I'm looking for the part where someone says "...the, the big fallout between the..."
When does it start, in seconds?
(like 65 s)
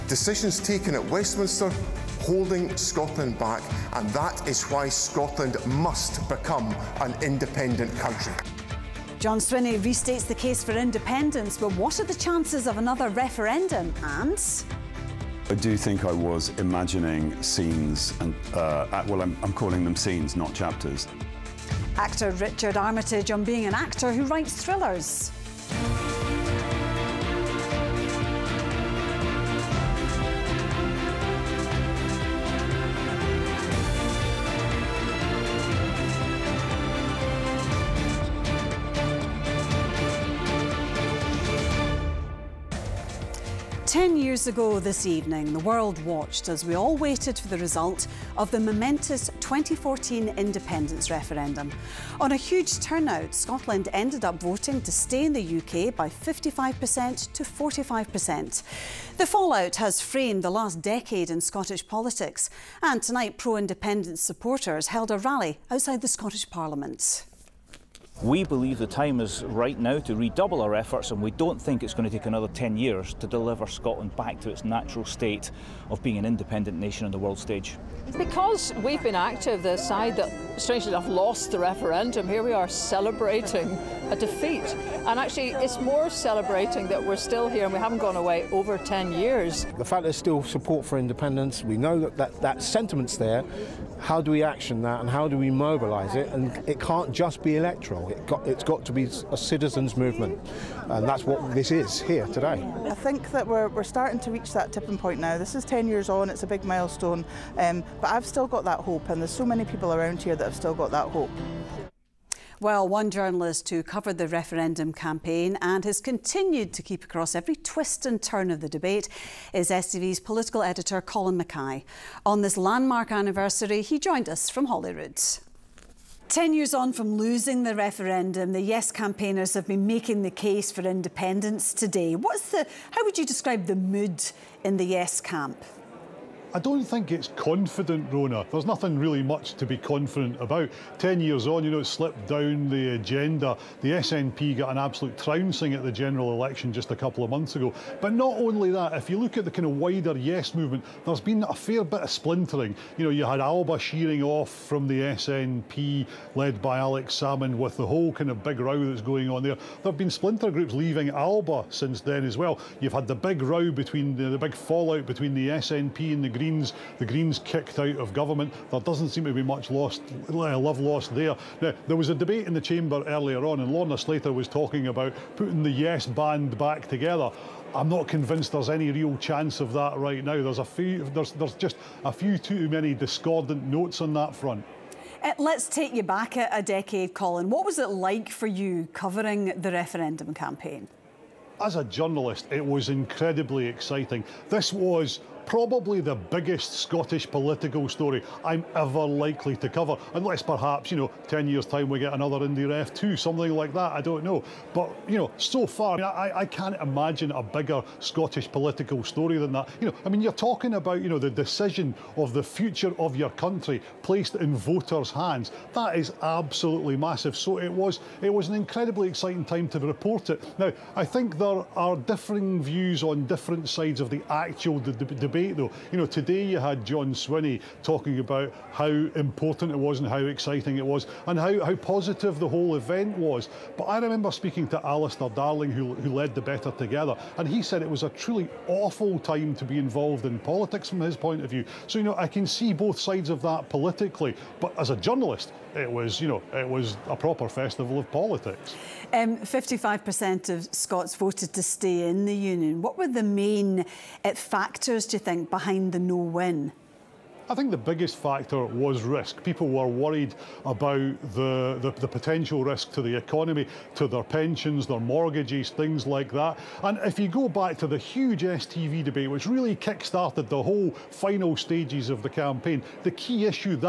164 s.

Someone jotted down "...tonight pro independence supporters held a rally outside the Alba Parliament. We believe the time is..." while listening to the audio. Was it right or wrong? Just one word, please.
wrong.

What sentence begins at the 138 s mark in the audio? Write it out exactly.
There's nothing really much to be confident about.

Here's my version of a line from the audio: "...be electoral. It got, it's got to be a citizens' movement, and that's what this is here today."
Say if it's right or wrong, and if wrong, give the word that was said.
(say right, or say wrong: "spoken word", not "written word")
right.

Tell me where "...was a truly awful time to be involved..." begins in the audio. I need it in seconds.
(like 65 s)
237 s.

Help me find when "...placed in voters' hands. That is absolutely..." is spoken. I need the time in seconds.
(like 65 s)
214 s.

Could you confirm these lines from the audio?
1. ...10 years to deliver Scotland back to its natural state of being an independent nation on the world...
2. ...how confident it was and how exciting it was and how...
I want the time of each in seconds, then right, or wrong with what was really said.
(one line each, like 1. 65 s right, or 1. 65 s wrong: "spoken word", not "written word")
1. 72 s right
2. 228 s wrong: "important", not "confident".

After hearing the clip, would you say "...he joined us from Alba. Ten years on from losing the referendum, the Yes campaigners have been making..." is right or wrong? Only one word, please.
wrong.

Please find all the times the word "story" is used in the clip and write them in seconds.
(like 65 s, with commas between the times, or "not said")
197 s, 209 s.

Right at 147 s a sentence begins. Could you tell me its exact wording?
But not only that, if you look at the kind of wider Yes movement, there's been a fair bit of splintering.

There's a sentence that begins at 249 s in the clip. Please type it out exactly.
55% um, of Scots voted to stay in the union.